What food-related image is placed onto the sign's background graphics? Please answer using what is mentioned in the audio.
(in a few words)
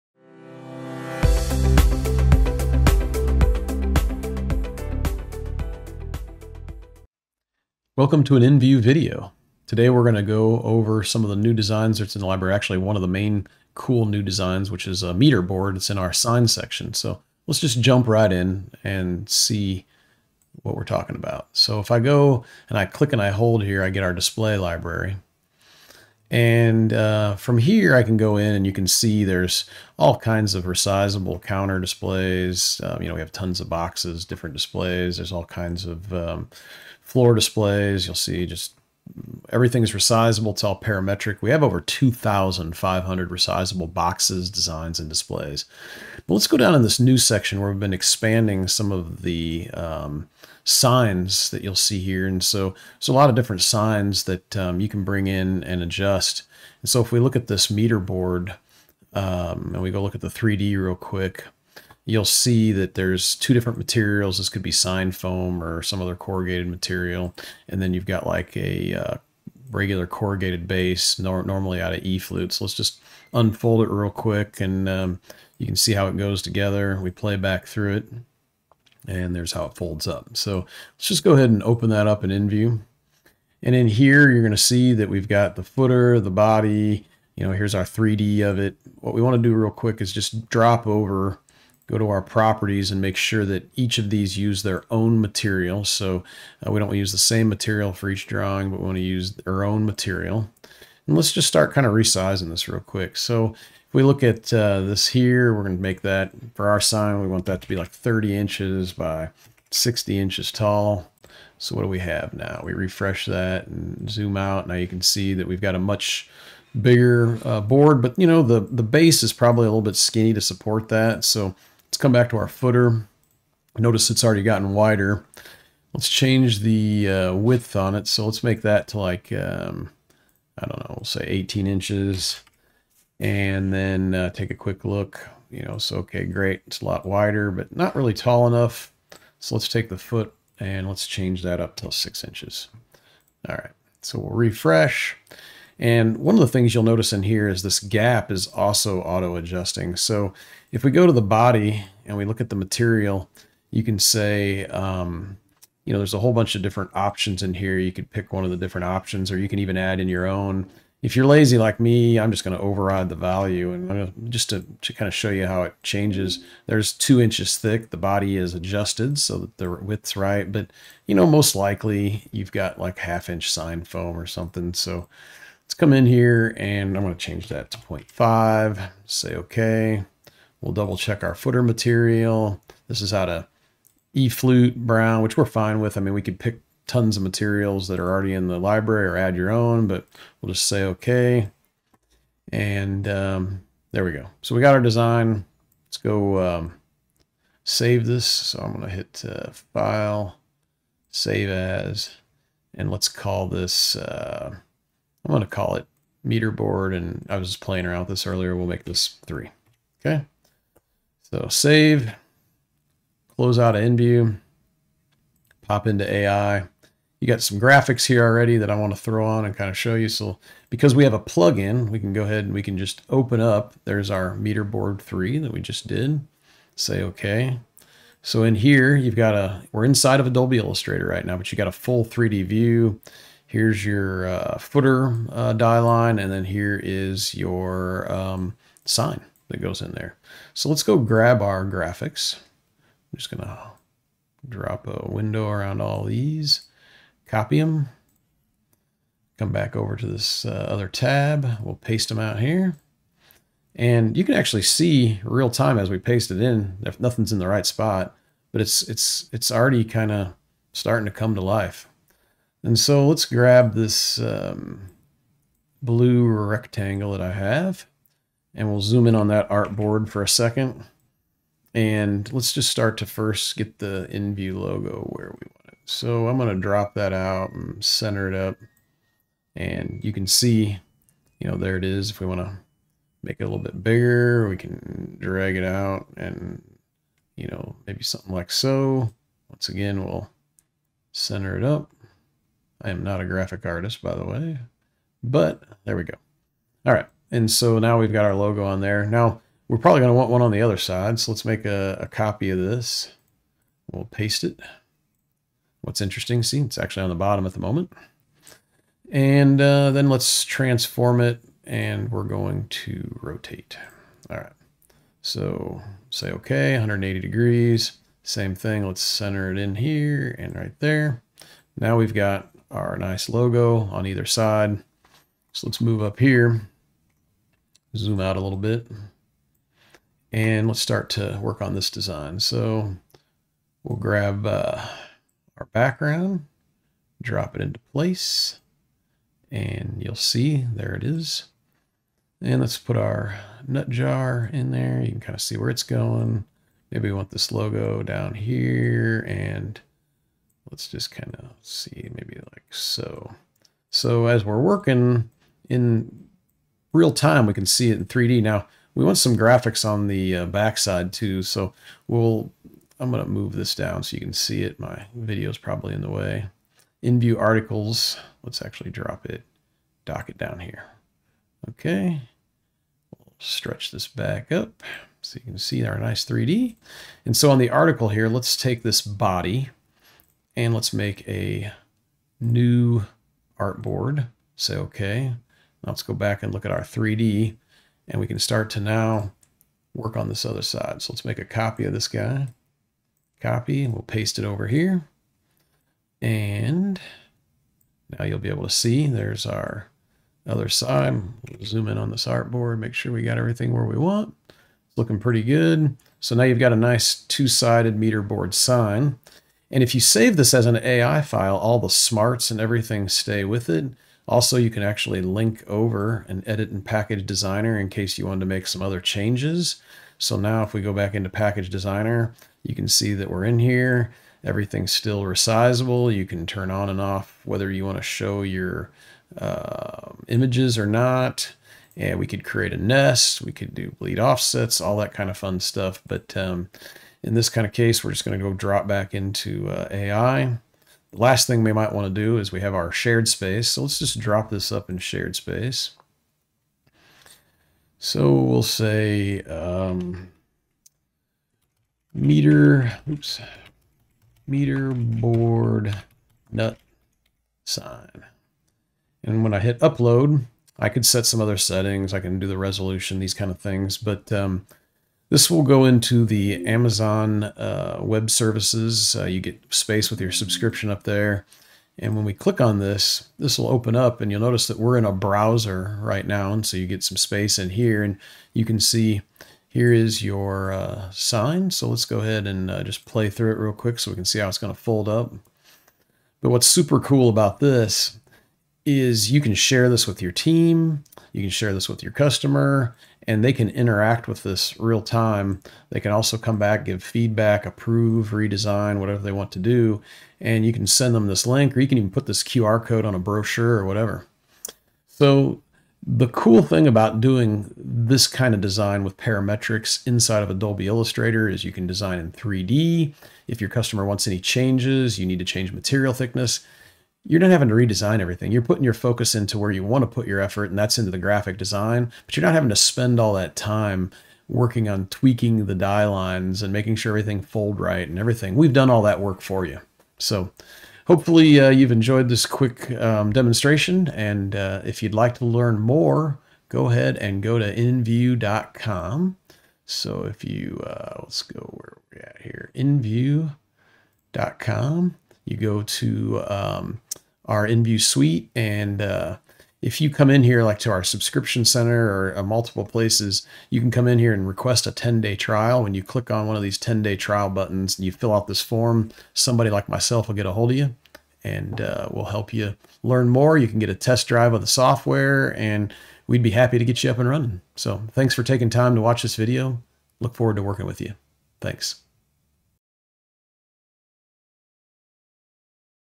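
nut jar.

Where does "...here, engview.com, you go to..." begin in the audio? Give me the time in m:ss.
9:02.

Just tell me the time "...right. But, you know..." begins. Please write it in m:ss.
2:50.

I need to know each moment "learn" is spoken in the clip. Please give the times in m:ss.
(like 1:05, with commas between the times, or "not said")
8:55, 9:23.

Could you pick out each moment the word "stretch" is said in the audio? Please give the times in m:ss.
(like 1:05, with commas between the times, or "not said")
6:13.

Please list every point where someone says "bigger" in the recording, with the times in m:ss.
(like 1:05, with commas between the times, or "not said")
1:56, 4:43.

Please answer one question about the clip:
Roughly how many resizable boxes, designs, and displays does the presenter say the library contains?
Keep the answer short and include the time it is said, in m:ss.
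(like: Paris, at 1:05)
2,500, at 0:41.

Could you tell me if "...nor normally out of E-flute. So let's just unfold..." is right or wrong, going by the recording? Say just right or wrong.
right.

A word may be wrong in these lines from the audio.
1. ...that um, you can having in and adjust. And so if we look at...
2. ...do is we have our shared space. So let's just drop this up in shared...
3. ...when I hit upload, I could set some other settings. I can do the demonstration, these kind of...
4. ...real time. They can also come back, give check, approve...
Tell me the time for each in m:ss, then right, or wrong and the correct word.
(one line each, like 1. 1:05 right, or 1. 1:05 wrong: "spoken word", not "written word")
1. 0:54 wrong: "bring", not "having"
2. 7:22 right
3. 7:39 wrong: "resolution", not "demonstration"
4. 8:14 wrong: "feedback", not "check".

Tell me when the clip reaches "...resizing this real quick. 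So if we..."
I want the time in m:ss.
1:41.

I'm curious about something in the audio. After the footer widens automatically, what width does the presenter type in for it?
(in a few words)
18 inches.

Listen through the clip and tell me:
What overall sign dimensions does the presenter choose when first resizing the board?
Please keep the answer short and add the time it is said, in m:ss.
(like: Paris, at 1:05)
30 by 60 inches, at 1:47.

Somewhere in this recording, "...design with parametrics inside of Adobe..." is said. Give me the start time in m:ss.
8:28.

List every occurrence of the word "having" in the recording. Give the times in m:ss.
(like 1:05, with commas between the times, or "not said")
8:37, 8:42.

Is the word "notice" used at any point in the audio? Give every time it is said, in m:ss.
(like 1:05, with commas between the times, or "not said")
2:03, 2:26, 7:54.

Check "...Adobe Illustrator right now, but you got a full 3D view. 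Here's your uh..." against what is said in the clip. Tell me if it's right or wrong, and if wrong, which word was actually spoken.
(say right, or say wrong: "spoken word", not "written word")
right.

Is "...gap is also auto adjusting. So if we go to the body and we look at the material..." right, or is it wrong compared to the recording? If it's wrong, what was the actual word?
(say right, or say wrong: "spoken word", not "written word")
right.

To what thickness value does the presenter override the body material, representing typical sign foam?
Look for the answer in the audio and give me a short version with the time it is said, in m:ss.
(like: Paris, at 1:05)
0.5, at 2:57.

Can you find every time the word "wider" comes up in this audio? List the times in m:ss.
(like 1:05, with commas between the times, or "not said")
2:04, 2:17.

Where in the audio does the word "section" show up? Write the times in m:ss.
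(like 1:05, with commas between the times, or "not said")
0:16, 0:47.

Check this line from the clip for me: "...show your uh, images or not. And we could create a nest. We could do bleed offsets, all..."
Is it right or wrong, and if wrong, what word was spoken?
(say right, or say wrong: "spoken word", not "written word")
right.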